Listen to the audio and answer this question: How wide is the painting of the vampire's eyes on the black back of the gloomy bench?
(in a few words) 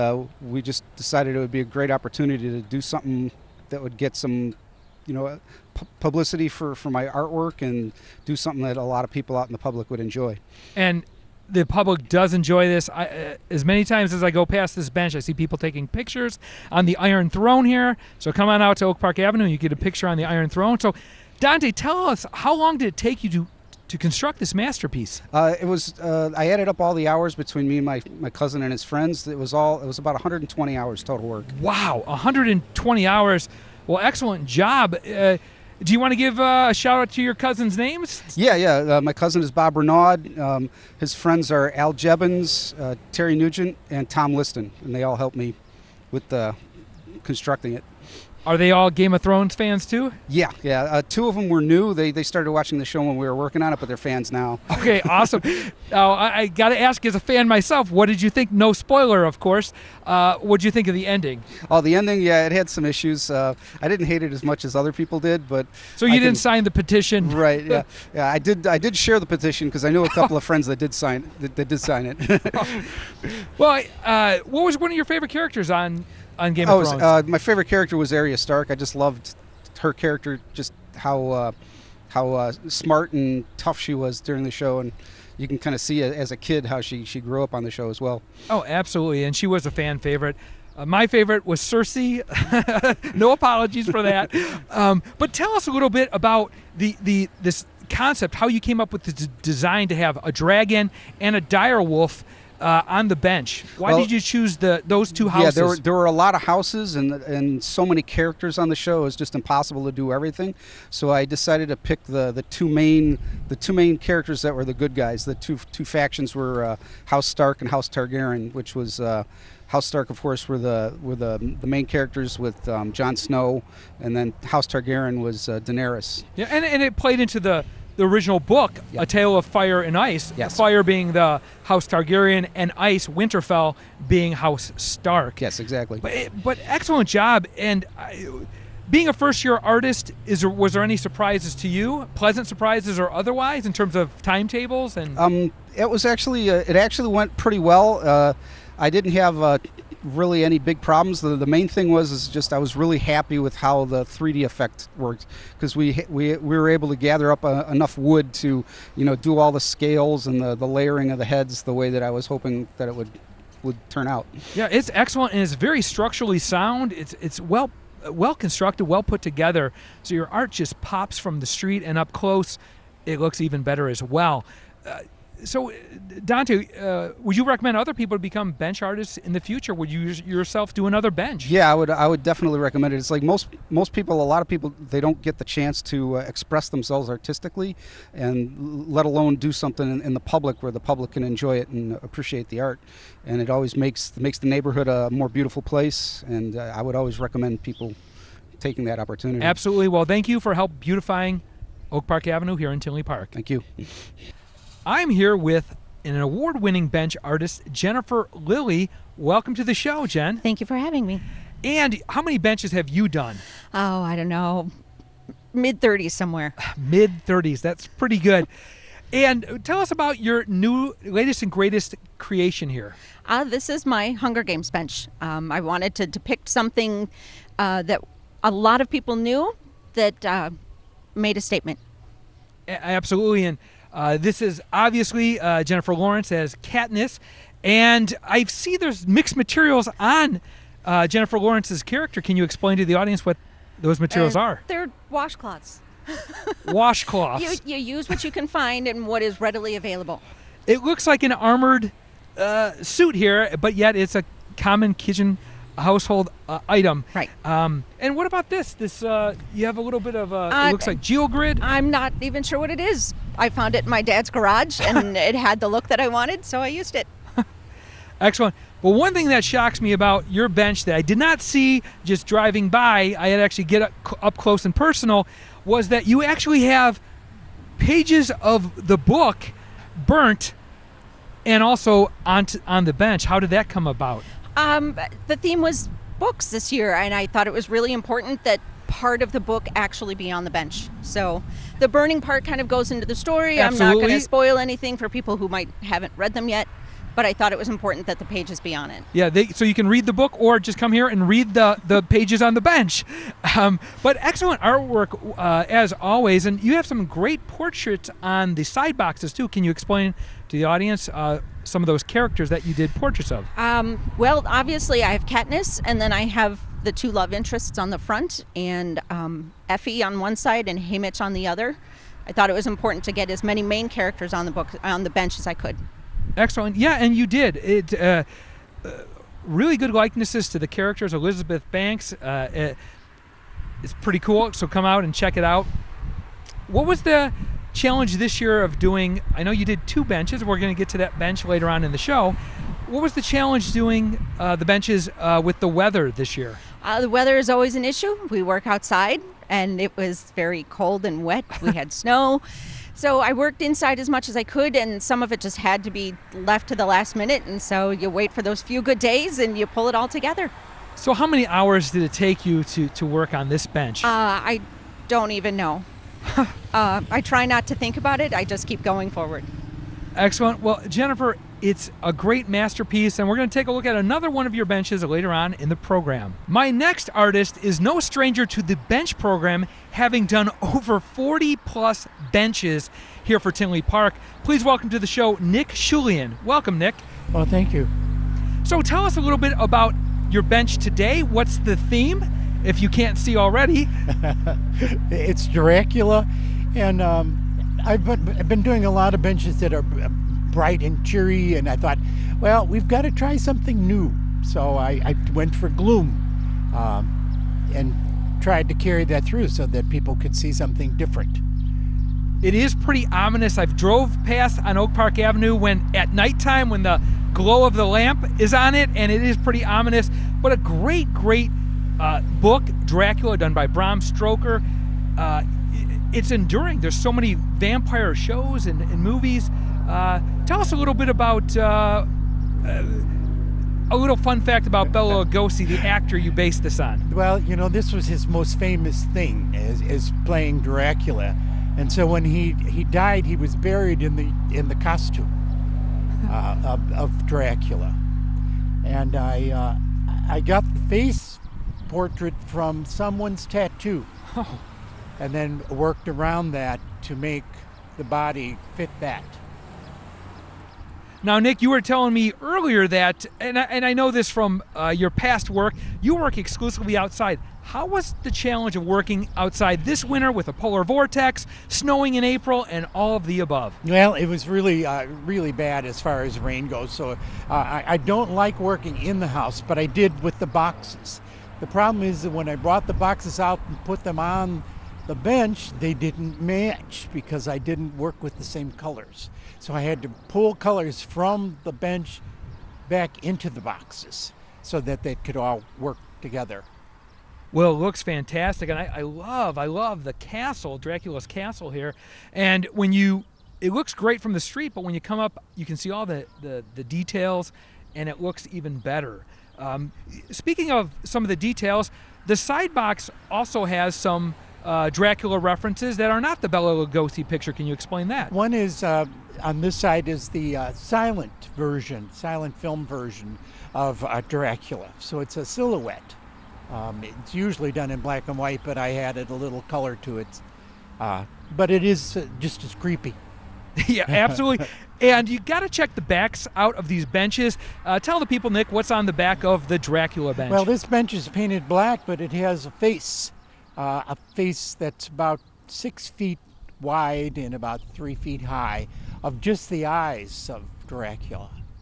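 6 feet.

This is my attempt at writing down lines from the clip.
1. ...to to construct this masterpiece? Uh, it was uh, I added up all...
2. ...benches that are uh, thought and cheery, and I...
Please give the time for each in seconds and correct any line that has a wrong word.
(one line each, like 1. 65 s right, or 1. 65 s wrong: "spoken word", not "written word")
1. 23 s right
2. 399 s wrong: "bright", not "thought".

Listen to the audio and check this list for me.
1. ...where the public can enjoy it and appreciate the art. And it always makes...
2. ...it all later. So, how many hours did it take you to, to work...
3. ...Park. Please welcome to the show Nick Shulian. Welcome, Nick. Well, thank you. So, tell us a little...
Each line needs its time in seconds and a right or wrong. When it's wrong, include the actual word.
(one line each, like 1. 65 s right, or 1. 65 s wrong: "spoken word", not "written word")
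1. 190 s right
2. 359 s wrong: "together", not "later"
3. 383 s right.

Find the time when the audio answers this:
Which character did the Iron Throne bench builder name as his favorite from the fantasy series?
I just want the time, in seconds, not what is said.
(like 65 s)
78 s.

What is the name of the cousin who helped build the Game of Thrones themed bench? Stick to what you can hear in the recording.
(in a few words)
Bob Renaud.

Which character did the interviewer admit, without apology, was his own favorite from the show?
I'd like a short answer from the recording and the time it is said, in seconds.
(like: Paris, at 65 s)
Cersei, at 91 s.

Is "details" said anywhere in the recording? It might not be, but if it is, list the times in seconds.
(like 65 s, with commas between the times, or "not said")
506 s, 511 s.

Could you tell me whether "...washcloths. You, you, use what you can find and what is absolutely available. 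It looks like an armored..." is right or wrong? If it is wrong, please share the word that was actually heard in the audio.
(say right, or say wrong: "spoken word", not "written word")
wrong: "readily", not "absolutely".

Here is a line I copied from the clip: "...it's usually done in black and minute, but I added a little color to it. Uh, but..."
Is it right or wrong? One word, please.
wrong.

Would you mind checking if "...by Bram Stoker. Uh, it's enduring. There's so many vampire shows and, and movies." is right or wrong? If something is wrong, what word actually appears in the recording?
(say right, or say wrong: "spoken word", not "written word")
right.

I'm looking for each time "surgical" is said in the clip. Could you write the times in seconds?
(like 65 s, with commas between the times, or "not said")
not said.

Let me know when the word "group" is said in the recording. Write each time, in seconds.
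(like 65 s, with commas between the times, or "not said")
not said.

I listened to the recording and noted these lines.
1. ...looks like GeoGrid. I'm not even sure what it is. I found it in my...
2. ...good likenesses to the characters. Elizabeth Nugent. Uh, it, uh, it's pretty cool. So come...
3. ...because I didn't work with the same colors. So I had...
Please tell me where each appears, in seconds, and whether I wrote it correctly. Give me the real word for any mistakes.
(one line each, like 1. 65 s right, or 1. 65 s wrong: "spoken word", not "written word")
1. 260 s right
2. 329 s wrong: "Banks", not "Nugent"
3. 487 s right.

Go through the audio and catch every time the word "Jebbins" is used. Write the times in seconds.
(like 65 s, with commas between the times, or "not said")
41 s.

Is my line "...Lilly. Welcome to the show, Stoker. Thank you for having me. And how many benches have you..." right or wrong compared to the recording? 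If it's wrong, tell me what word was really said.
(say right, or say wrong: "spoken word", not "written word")
wrong: "Jen", not "Stoker".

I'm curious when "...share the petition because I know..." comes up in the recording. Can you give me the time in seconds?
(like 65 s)
68 s.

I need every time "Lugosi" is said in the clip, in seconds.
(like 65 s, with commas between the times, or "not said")
435 s, 516 s.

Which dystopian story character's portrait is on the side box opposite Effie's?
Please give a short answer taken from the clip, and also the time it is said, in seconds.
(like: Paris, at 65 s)
Haymitch, at 320 s.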